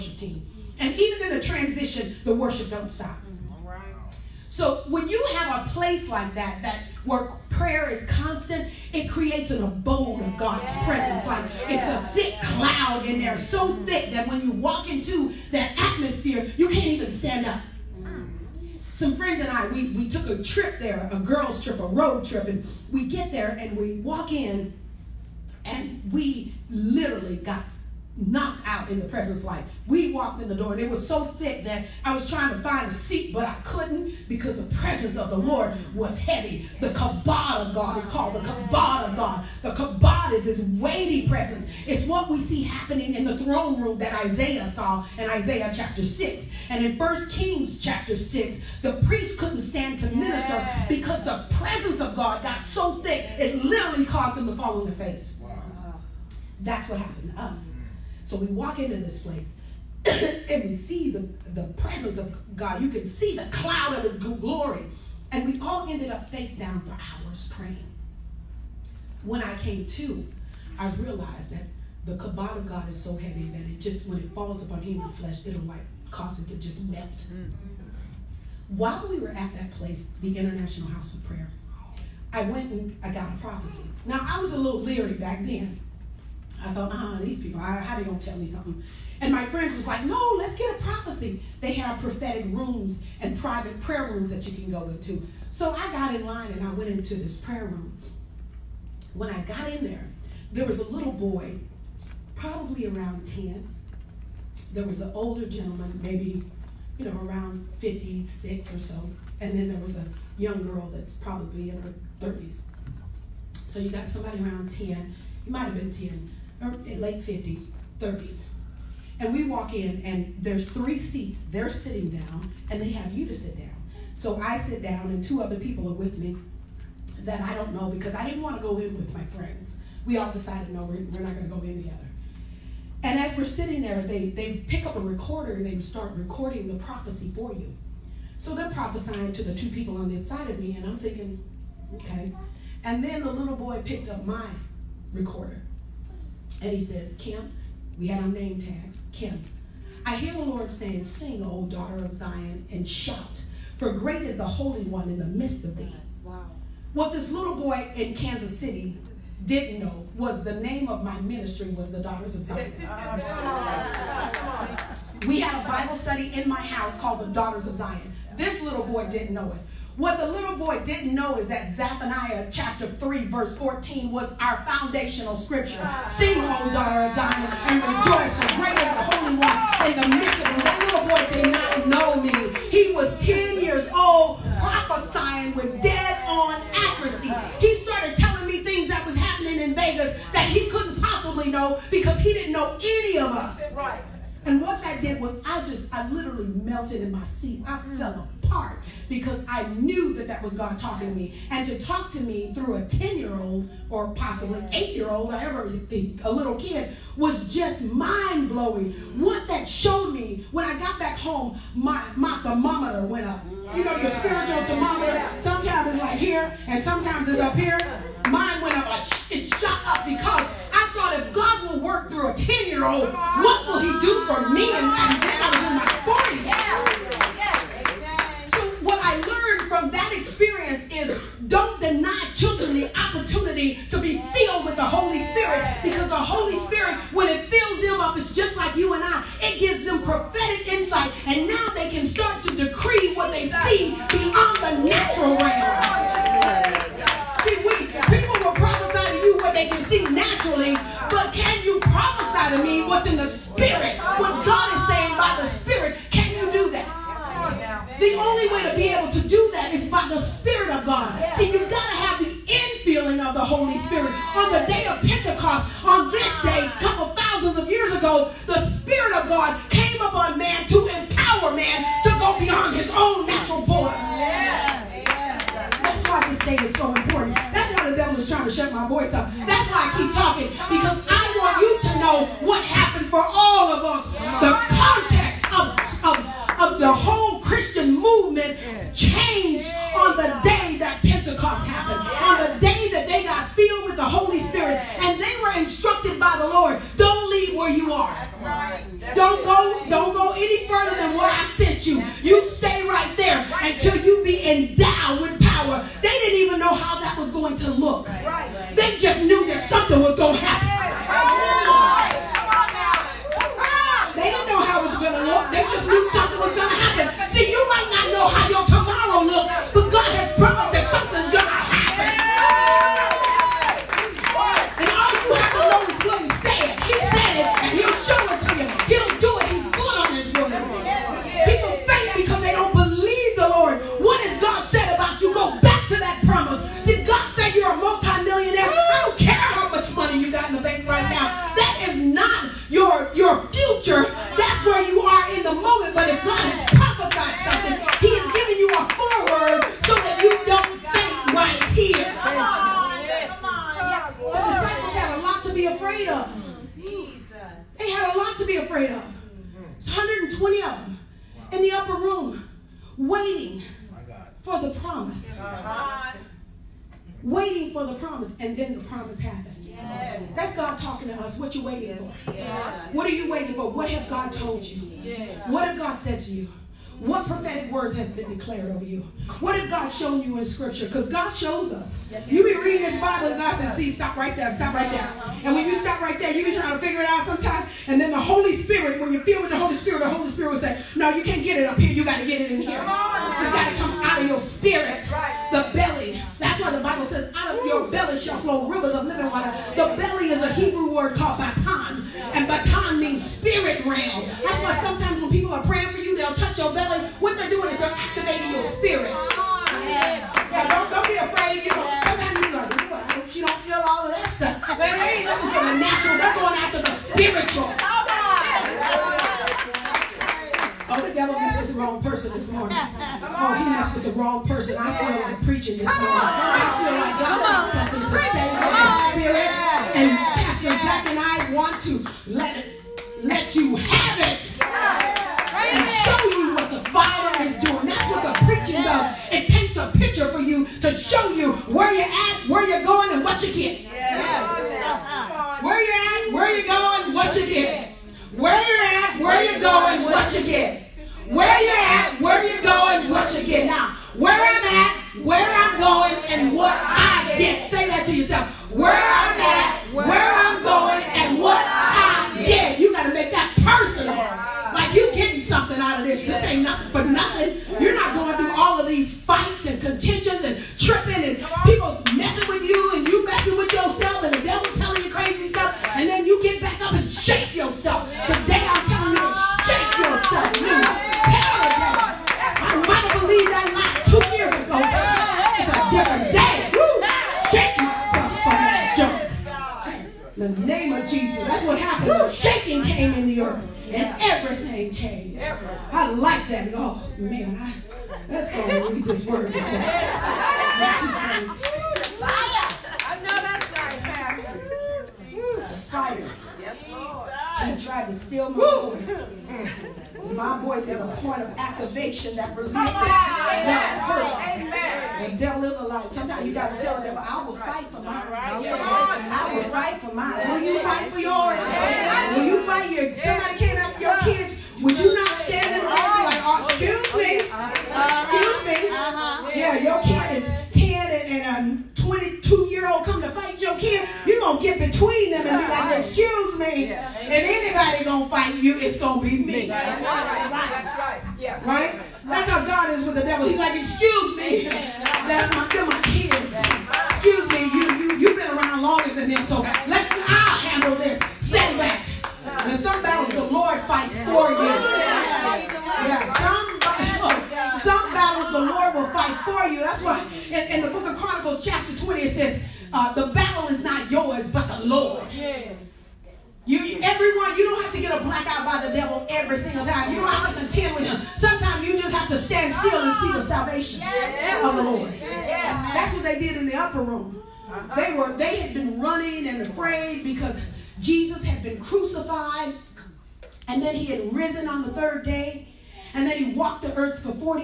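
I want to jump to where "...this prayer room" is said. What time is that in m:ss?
1:37.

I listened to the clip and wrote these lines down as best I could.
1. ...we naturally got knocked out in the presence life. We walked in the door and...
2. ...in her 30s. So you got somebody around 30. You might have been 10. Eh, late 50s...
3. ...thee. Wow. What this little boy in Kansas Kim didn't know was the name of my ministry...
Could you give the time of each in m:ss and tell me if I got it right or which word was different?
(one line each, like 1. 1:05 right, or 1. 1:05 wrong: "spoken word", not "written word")
1. 0:26 wrong: "literally", not "naturally"
2. 1:51 wrong: "10", not "30"
3. 2:35 wrong: "City", not "Kim".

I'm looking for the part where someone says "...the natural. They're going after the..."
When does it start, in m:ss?
6:55.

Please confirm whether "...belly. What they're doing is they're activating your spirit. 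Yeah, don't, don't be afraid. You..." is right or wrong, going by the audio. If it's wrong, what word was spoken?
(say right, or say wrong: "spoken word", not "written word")
right.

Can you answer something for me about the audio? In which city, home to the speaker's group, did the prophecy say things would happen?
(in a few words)
Vegas.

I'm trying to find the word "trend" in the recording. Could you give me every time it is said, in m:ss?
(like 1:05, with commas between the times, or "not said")
not said.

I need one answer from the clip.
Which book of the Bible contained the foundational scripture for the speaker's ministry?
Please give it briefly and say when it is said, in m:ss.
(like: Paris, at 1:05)
Zephaniah, at 2:51.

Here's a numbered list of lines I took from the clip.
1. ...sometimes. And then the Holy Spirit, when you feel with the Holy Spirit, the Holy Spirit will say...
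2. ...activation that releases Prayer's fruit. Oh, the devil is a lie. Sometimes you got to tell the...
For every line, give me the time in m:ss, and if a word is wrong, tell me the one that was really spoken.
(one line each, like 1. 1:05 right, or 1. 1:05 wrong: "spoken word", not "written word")
1. 6:27 right
2. 8:31 wrong: "God", not "Prayer".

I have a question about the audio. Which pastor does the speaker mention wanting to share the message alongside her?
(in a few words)
Pastor Jack.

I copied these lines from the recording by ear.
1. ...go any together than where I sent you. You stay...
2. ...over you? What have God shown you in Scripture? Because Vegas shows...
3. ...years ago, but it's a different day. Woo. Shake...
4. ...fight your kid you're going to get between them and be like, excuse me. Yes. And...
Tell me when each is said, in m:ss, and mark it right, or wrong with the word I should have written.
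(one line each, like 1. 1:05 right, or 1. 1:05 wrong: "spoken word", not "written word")
1. 5:00 wrong: "further", not "together"
2. 6:18 wrong: "God", not "Vegas"
3. 8:04 right
4. 8:53 right.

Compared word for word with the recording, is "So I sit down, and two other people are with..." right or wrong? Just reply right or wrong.
right.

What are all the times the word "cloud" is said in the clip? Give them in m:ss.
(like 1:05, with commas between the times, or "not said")
0:12, 1:03.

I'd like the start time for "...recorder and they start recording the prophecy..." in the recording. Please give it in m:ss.
2:14.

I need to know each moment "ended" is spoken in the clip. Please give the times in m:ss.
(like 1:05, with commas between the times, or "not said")
1:05.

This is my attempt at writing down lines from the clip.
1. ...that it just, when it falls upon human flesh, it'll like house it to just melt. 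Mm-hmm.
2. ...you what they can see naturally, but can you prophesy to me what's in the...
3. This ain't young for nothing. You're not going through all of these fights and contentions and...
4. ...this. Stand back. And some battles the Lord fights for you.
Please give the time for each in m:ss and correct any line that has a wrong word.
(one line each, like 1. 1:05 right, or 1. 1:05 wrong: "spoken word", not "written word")
1. 1:13 wrong: "cause", not "house"
2. 4:09 right
3. 7:46 wrong: "nothing", not "young"
4. 9:10 right.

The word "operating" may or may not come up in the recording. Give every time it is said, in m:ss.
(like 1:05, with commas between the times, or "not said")
not said.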